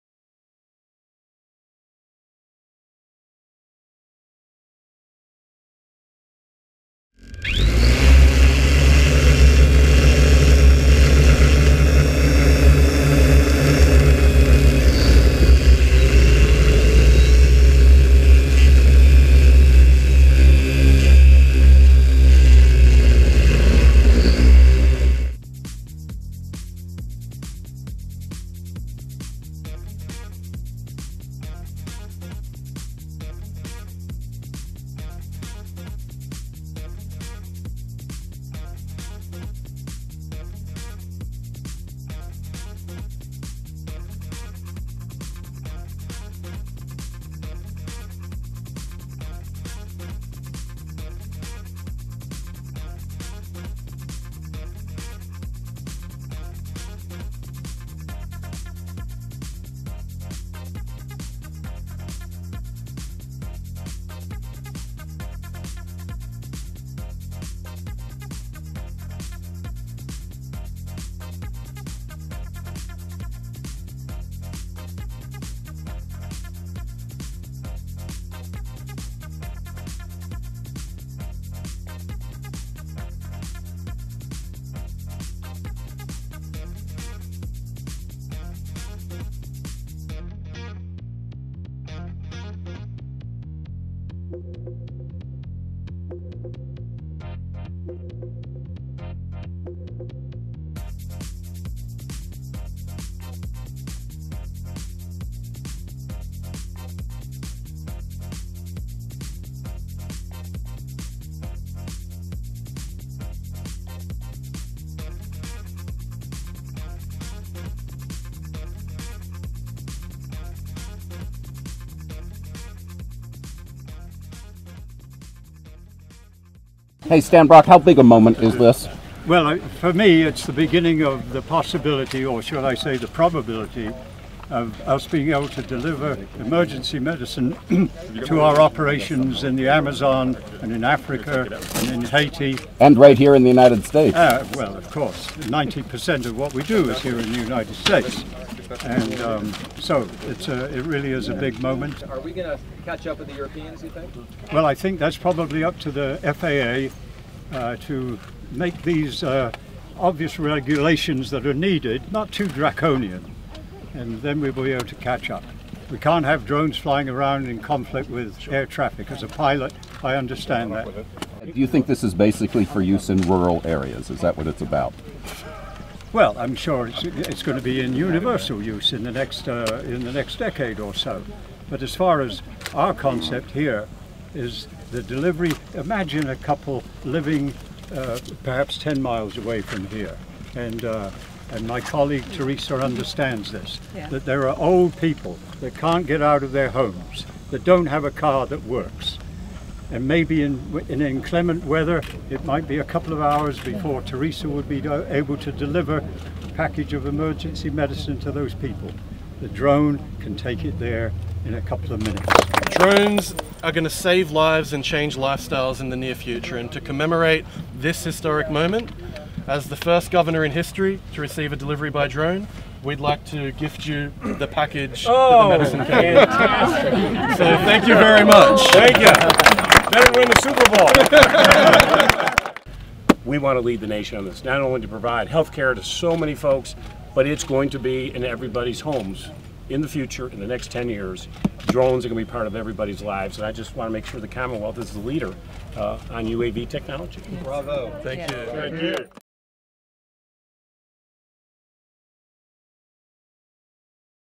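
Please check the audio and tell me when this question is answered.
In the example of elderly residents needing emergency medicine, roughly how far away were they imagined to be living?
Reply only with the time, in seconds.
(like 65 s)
188 s.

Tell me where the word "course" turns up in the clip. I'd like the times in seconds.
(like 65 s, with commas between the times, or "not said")
144 s.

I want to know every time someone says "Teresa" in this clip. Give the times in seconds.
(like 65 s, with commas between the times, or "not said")
192 s, 204 s.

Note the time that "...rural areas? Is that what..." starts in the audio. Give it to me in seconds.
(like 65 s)
173 s.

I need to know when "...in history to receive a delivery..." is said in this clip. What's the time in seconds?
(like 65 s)
220 s.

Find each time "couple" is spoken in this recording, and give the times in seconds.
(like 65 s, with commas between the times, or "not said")
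186 s, 202 s, 211 s.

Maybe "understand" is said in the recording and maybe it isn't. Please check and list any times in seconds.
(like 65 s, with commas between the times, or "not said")
170 s, 192 s.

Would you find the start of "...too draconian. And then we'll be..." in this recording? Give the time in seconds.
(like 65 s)
162 s.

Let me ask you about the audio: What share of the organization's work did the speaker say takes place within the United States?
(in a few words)
90%.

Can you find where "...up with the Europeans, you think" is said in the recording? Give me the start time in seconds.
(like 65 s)
153 s.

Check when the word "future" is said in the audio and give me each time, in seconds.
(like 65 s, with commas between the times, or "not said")
216 s, 239 s.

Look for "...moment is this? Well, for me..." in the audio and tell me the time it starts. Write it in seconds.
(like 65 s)
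128 s.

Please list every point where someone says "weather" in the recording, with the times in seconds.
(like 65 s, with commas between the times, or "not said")
201 s.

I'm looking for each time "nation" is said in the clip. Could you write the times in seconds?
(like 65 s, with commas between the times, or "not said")
233 s.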